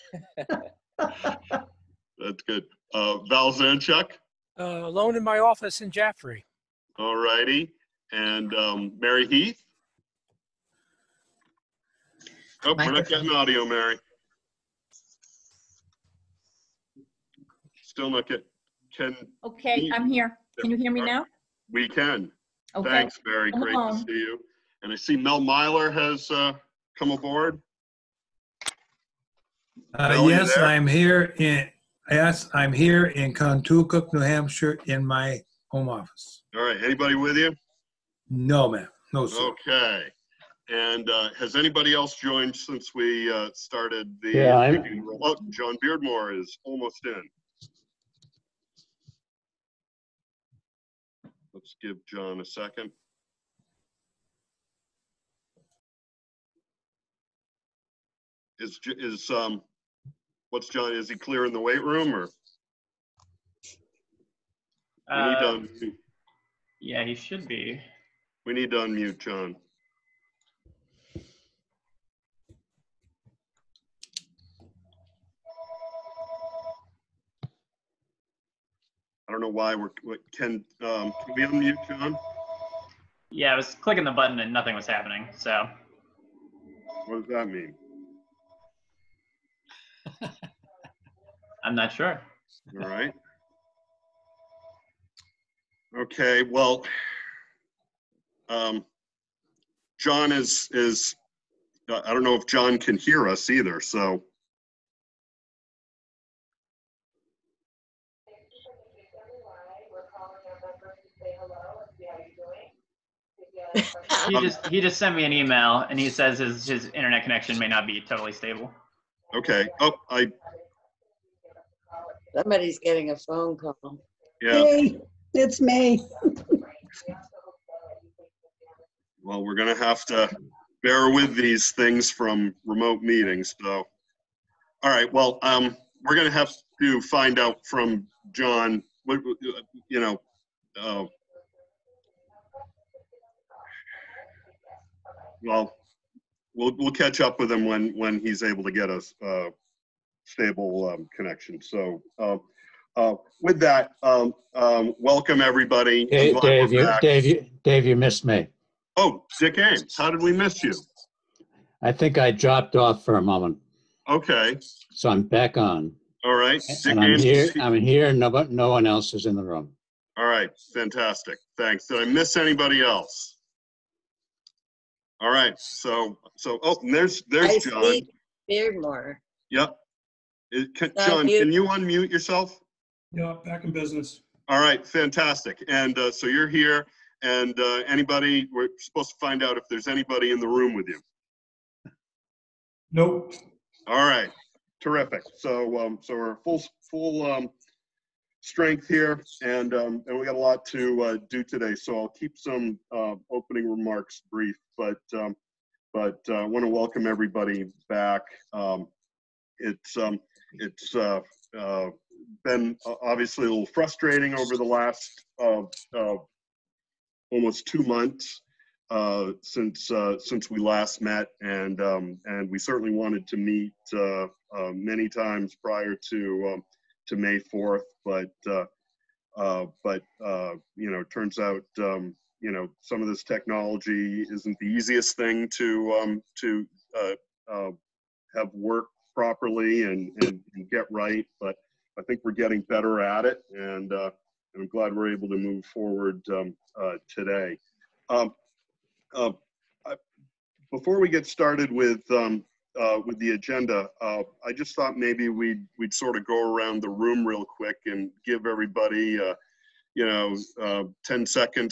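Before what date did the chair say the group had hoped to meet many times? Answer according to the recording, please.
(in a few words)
May 4th.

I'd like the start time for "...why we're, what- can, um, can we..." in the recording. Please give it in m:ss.
1:19.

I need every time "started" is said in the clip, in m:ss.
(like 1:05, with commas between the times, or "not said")
0:43, 4:11.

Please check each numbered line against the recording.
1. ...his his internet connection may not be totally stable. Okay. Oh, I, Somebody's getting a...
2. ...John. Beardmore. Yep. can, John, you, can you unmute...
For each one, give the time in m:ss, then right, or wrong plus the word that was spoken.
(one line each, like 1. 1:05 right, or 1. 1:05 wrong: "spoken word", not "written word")
1. 1:56 right
2. 2:57 right.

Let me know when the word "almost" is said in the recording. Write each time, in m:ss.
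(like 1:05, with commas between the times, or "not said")
0:46, 3:35.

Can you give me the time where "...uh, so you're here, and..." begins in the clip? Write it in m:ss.
3:05.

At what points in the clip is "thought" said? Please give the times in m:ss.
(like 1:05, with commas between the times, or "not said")
4:14.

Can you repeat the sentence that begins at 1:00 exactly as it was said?
Is he clear in the weight room or?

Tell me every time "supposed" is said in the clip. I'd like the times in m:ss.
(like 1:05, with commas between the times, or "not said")
3:08.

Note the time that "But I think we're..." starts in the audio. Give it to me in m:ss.
4:01.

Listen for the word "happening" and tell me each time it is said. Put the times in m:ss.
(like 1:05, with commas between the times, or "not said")
1:24.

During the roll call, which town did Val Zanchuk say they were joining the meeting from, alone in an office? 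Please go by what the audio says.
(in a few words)
Jaffrey.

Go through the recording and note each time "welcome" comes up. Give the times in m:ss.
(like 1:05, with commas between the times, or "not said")
2:34, 3:26.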